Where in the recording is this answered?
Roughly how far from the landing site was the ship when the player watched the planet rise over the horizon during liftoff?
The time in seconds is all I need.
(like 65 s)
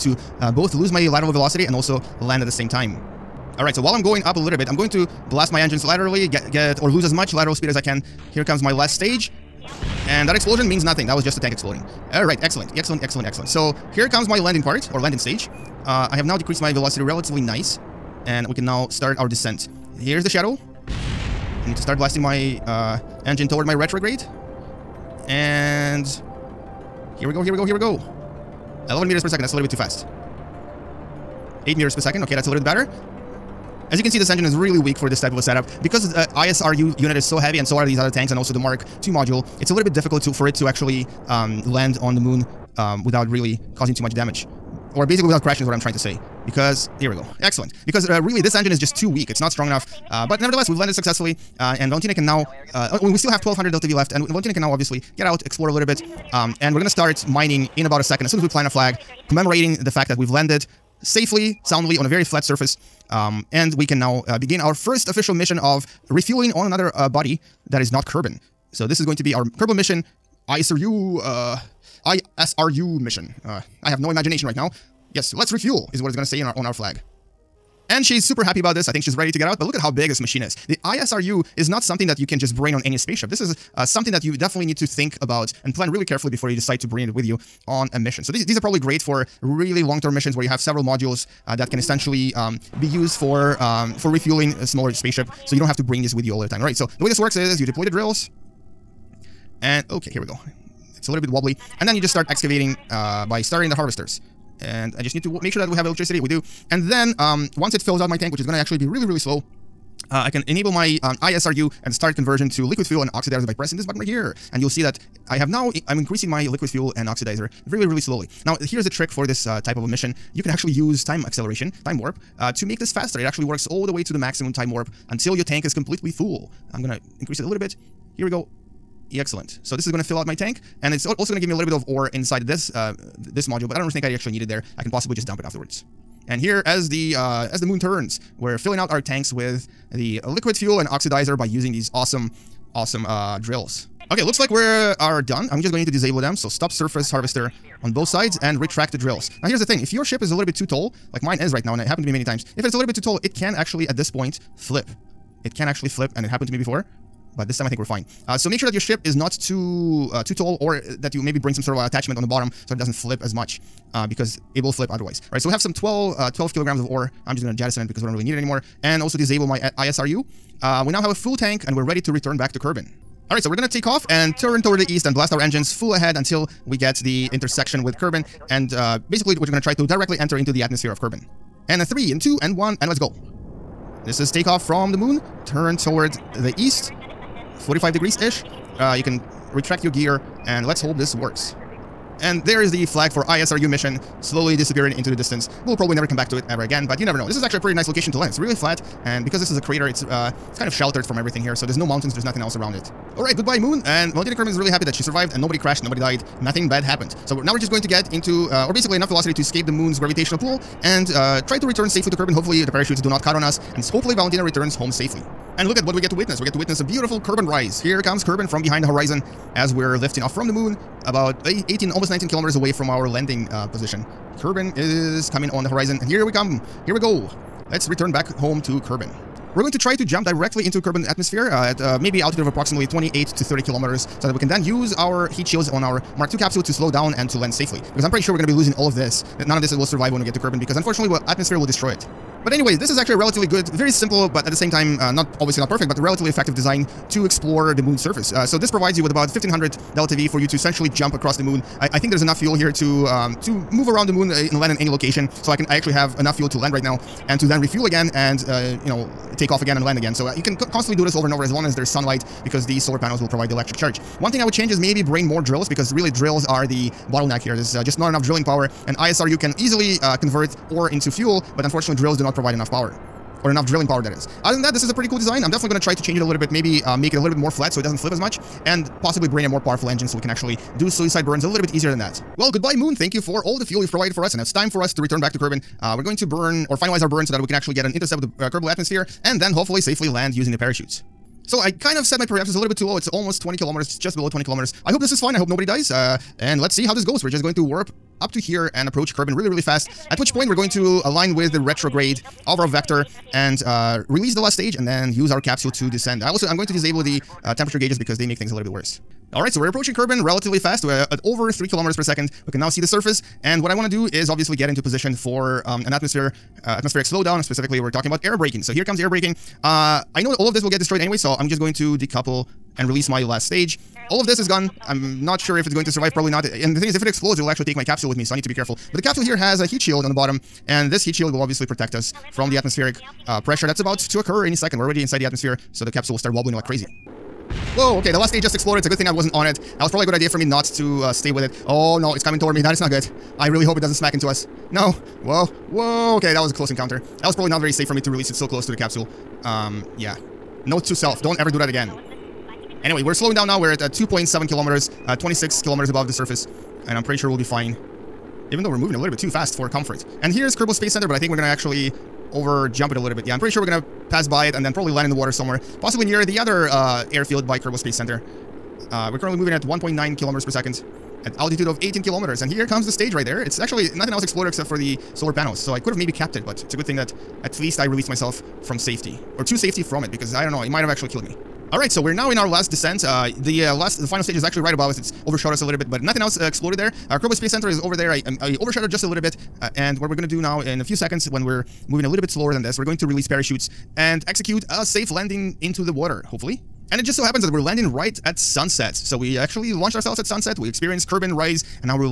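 221 s.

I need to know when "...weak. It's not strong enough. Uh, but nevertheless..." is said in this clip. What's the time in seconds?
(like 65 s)
49 s.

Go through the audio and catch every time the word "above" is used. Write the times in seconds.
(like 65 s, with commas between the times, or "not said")
355 s, 384 s.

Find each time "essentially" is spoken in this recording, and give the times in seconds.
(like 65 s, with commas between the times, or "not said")
91 s, 250 s.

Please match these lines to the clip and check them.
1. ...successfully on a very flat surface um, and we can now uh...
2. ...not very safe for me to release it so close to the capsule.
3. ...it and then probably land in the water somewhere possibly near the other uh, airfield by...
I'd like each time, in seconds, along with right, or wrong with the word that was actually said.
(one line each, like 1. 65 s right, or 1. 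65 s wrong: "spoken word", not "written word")
1. 61 s wrong: "soundly", not "successfully"
2. 347 s right
3. 364 s right.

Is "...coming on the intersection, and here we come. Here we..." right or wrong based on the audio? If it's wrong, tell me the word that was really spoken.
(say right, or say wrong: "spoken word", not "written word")
wrong: "horizon", not "intersection".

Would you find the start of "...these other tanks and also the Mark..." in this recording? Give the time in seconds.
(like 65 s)
37 s.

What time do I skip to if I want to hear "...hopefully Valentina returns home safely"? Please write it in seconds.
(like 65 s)
213 s.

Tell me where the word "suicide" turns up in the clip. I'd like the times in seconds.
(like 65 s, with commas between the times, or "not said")
280 s.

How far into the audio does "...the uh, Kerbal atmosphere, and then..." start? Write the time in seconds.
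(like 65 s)
288 s.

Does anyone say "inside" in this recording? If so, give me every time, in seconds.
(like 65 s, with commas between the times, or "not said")
132 s, 335 s.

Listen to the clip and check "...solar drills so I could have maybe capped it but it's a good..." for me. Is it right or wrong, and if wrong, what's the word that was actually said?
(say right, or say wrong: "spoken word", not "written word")
wrong: "panels", not "drills".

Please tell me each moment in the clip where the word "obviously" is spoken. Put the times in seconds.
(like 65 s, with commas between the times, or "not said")
54 s, 245 s, 314 s, 331 s.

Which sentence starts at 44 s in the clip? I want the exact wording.
Or basically without crashing is what I'm trying to say.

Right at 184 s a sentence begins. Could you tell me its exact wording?
This is takeoff from the moon, turn toward the east, 45 degrees-ish.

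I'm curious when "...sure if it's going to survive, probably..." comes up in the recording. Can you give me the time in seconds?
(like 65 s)
325 s.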